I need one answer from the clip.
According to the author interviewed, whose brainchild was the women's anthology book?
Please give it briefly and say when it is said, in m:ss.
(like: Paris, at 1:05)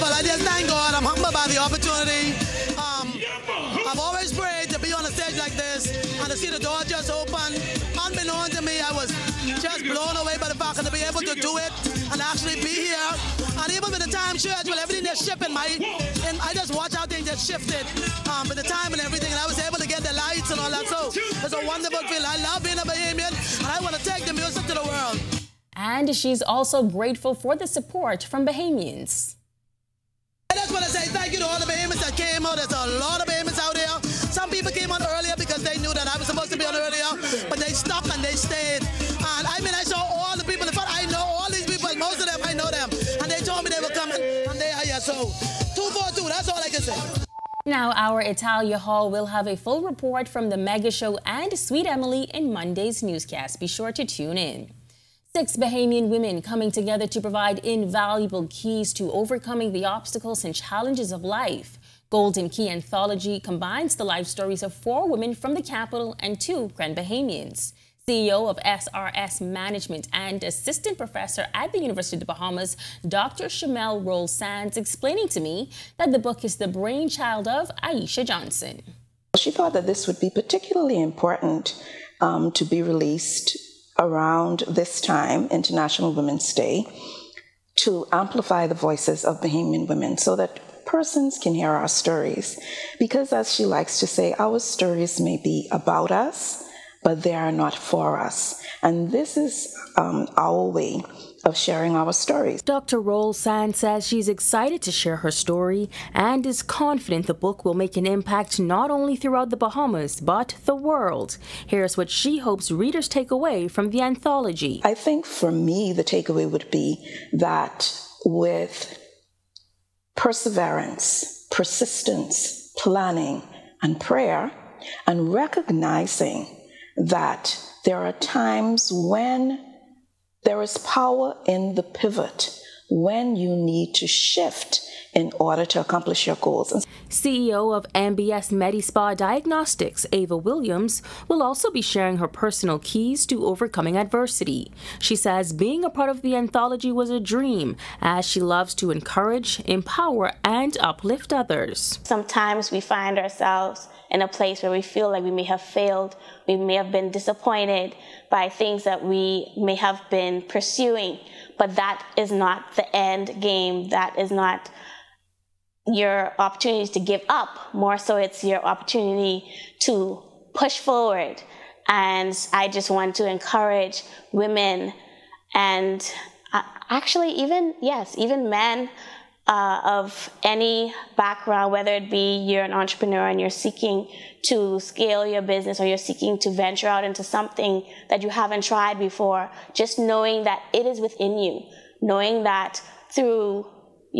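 Aisha Johnson, at 1:17.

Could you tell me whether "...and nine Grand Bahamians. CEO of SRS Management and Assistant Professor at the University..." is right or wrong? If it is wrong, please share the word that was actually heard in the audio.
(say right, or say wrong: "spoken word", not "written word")
wrong: "two", not "nine".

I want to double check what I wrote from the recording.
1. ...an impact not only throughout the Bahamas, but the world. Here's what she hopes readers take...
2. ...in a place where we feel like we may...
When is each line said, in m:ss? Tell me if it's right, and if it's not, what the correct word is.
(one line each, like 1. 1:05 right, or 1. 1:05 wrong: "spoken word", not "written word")
1. 1:47 right
2. 2:34 right.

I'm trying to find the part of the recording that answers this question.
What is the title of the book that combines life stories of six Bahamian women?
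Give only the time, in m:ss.
1:02.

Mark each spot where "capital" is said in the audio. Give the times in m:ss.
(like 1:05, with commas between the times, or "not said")
1:05.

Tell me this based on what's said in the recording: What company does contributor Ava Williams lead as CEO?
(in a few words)
MBS MediSpa Diagnostics.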